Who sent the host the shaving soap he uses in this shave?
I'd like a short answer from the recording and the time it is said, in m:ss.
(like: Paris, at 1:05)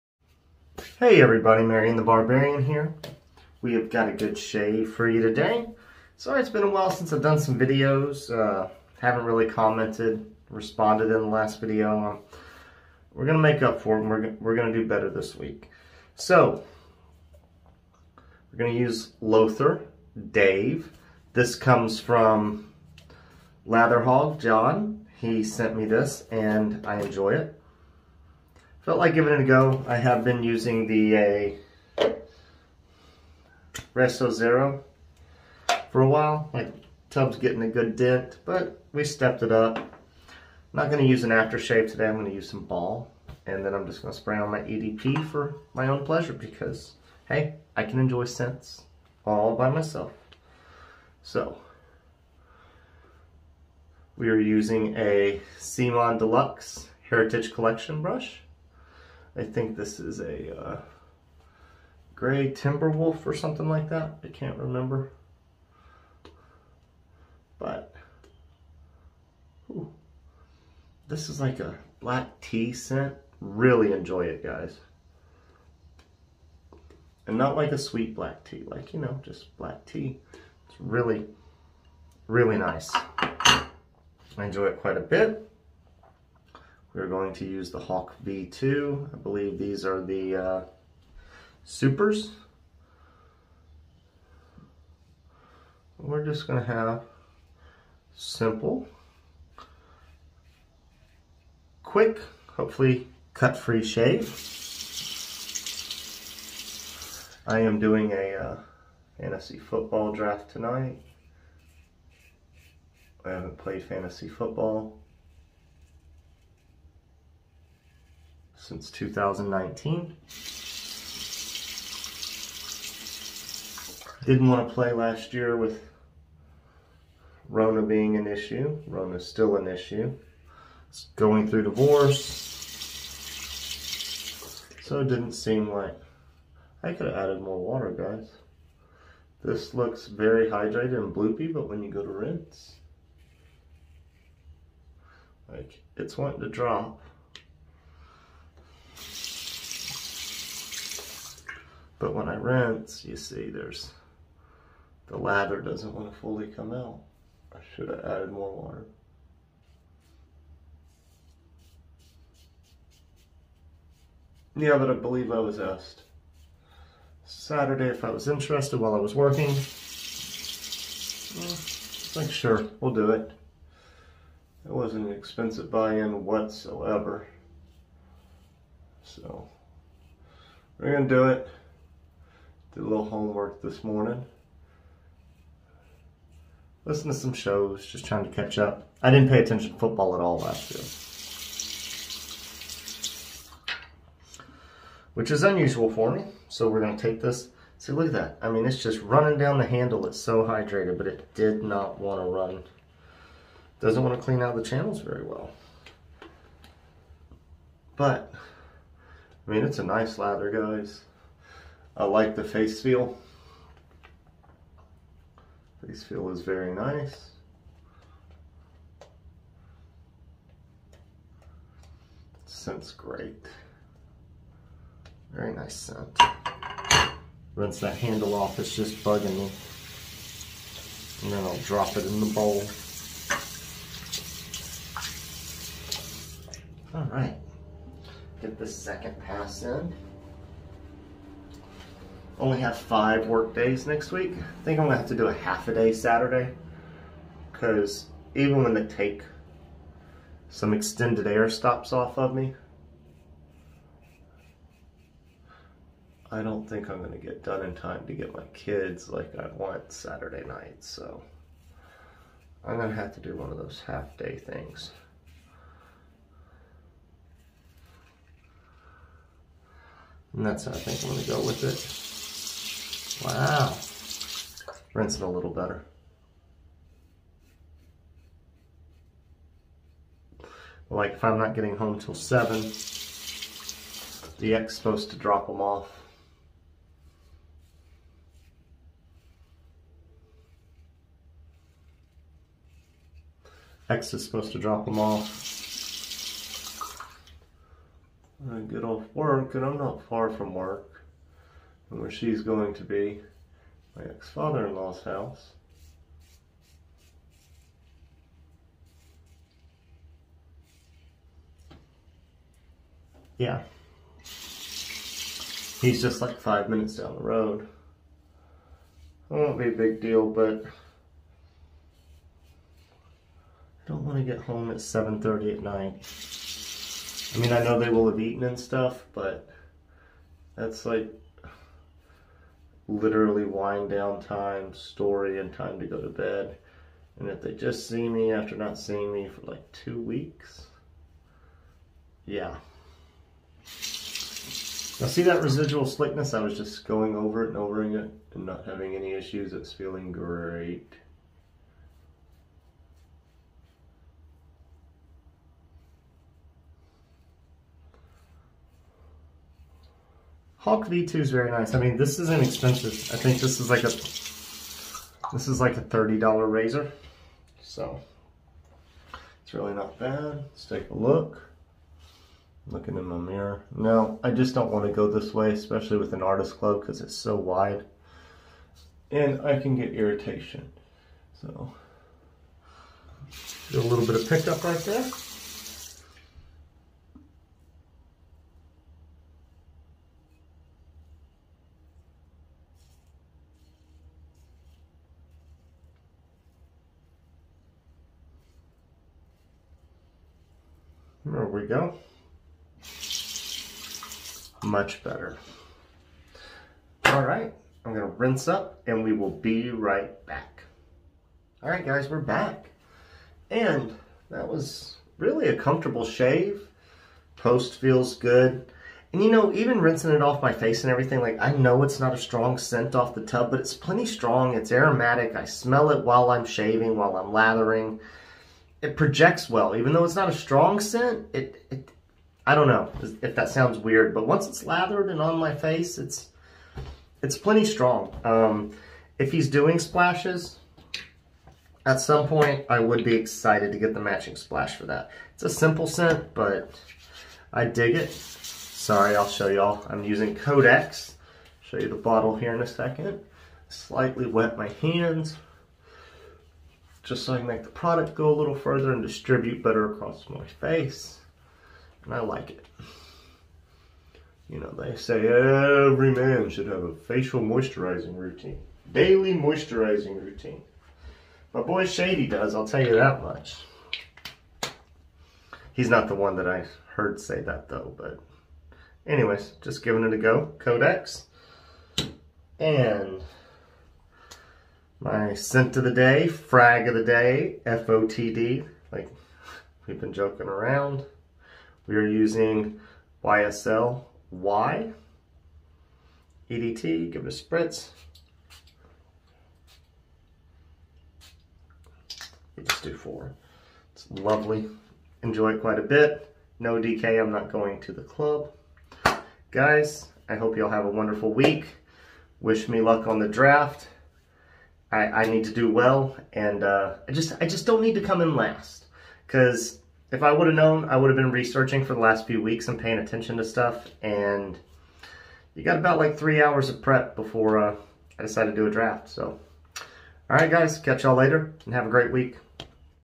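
Latherhog John, at 0:23.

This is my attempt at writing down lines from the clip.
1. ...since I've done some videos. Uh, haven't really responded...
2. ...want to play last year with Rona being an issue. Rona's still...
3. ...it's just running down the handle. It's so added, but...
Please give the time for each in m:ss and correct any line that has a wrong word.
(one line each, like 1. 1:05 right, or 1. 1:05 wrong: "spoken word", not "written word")
1. 0:06 wrong: "commented", not "responded"
2. 2:04 right
3. 3:18 wrong: "hydrated", not "added".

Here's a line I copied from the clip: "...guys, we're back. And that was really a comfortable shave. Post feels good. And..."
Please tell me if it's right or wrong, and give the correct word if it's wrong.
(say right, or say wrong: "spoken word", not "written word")
right.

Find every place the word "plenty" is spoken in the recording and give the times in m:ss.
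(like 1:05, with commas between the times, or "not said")
7:03, 7:17.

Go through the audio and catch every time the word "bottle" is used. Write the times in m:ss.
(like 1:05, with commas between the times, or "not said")
7:31.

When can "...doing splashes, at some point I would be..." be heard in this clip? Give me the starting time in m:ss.
7:19.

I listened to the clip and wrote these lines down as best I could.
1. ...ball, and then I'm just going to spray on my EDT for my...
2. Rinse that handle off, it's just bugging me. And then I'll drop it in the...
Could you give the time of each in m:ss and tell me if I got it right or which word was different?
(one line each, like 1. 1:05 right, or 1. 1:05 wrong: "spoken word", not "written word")
1. 0:42 wrong: "EDP", not "EDT"
2. 3:47 right.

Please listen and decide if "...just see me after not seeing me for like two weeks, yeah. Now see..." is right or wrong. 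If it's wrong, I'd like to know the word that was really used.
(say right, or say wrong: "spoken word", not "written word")
right.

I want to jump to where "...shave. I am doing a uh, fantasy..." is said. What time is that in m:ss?
1:43.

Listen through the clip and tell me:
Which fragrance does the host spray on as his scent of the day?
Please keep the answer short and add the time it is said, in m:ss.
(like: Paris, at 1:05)
YSL Y, at 8:13.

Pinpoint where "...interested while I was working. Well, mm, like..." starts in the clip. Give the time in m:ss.
2:48.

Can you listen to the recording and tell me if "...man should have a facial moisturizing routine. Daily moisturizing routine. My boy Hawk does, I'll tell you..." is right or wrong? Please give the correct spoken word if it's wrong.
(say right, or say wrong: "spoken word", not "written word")
wrong: "Shady", not "Hawk".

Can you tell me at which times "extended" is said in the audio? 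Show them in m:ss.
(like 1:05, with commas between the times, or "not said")
4:10.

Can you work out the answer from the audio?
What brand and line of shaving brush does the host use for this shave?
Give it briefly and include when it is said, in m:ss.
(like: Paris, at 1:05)
C-Mon Deluxe Heritage Collection, at 0:55.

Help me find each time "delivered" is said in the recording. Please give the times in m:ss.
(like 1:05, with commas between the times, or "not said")
not said.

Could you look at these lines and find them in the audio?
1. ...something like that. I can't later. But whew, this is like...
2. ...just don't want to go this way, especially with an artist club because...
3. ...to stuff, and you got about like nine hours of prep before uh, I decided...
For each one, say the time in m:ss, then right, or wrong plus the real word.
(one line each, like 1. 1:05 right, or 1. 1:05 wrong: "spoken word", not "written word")
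1. 1:03 wrong: "remember", not "later"
2. 6:14 right
3. 8:43 wrong: "three", not "nine".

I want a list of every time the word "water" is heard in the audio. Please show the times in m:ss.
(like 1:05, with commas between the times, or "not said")
2:17, 2:38.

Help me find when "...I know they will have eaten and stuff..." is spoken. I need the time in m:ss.
5:27.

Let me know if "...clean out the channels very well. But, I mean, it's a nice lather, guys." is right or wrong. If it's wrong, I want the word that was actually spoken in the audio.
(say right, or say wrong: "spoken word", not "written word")
right.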